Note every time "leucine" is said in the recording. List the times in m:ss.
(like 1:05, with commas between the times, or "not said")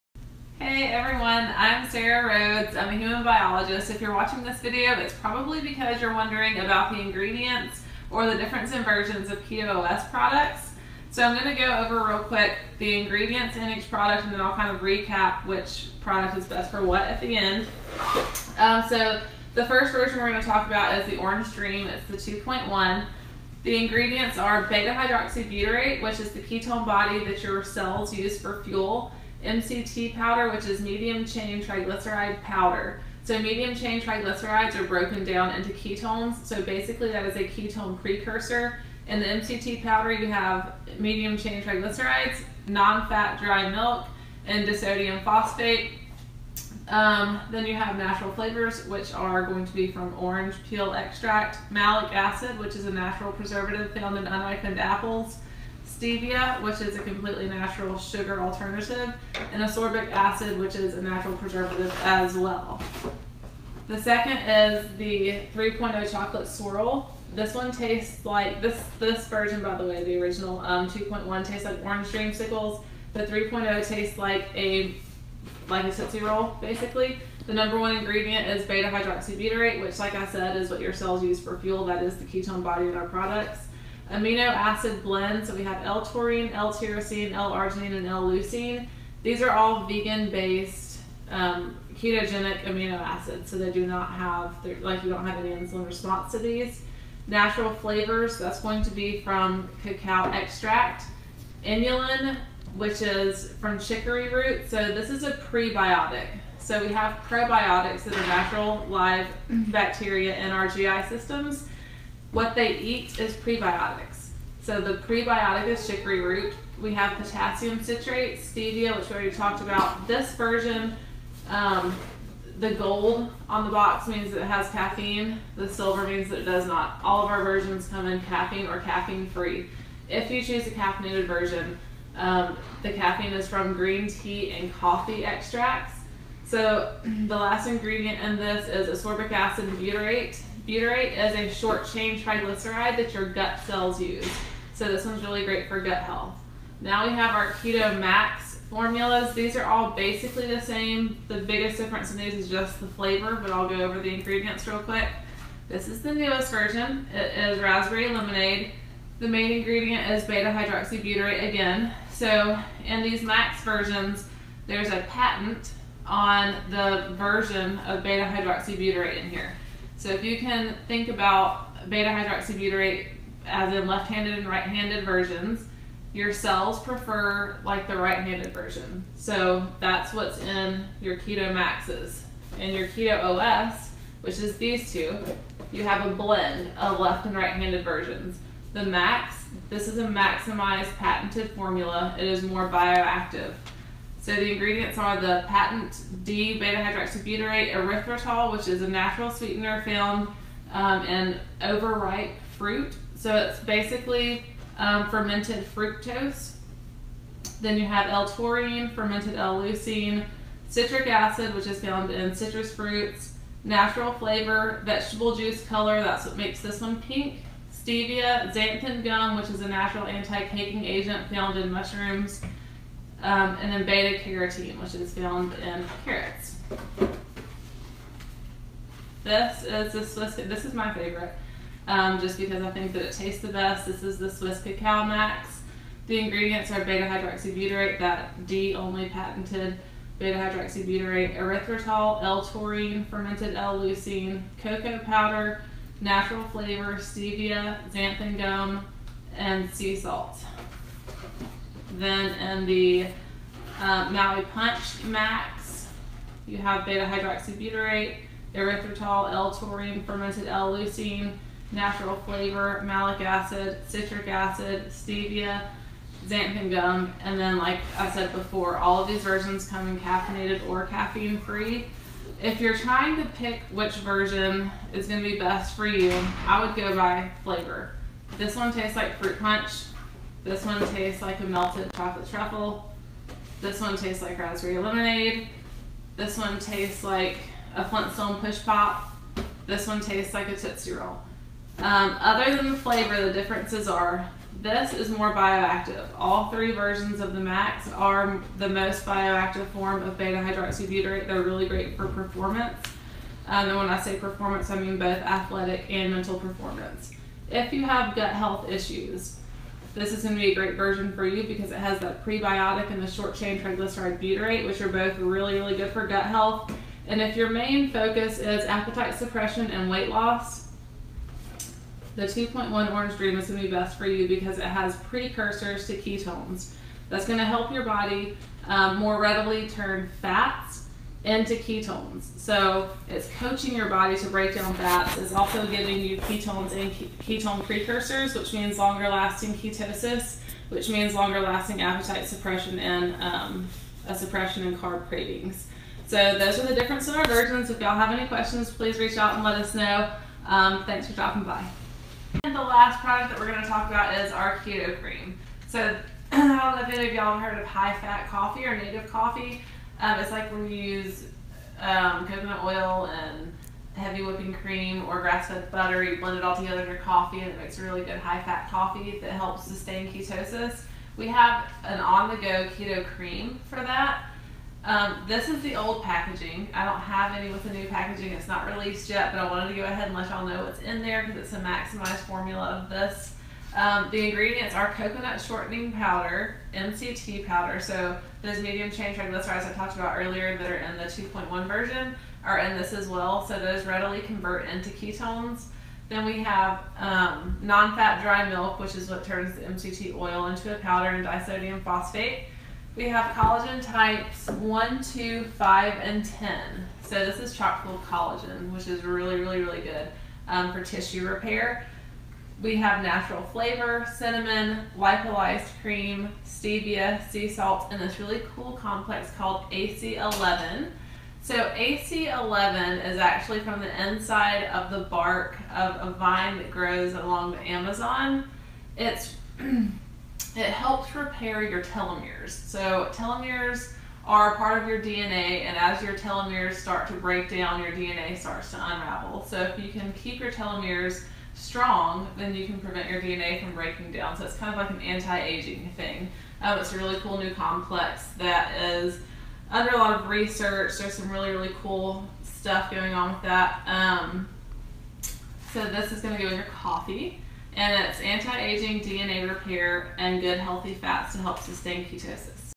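1:28, 3:29, 4:03, 4:20.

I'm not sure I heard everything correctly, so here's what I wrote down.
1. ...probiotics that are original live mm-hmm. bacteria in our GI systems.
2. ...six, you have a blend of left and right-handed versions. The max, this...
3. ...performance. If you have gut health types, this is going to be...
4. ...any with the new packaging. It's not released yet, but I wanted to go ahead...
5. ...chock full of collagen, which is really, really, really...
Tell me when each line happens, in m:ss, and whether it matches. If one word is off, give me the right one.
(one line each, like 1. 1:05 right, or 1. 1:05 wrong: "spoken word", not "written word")
1. 1:47 wrong: "natural", not "original"
2. 3:04 wrong: "two", not "six"
3. 5:06 wrong: "issues", not "types"
4. 6:17 right
5. 6:47 right.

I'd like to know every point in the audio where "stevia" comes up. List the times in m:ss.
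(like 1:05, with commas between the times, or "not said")
0:56, 1:58, 3:37, 4:06, 4:24, 6:56.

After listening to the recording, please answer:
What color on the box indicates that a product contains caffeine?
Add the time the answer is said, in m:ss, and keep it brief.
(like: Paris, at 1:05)
gold, at 2:02.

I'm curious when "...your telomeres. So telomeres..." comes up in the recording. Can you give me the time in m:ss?
7:11.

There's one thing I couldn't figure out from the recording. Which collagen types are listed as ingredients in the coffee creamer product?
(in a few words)
1, 2, 5, and 10.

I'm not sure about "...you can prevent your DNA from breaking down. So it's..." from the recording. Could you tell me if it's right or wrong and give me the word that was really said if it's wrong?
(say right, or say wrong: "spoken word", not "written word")
right.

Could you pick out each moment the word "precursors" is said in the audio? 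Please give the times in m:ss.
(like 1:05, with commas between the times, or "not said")
0:37, 5:24, 5:37.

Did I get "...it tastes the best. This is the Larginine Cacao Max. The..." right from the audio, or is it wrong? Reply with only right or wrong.
wrong.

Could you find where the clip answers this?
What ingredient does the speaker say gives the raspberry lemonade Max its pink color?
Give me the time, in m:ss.
3:34.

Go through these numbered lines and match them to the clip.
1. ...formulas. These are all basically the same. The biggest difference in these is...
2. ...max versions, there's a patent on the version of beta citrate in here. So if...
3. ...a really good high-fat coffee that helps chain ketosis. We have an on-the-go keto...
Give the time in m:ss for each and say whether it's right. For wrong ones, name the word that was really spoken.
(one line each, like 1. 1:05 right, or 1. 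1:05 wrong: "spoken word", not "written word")
1. 2:28 right
2. 2:43 wrong: "hydroxybutyrate", not "citrate"
3. 6:07 wrong: "sustain", not "chain".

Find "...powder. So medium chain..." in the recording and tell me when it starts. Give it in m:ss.
0:32.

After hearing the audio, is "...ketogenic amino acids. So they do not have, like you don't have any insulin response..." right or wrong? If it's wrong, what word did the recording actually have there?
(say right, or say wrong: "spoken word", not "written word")
right.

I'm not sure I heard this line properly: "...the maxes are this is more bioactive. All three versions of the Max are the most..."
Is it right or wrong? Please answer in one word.
wrong.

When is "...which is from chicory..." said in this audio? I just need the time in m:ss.
1:42.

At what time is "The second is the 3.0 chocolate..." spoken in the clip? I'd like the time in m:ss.
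1:03.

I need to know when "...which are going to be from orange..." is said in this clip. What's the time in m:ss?
0:48.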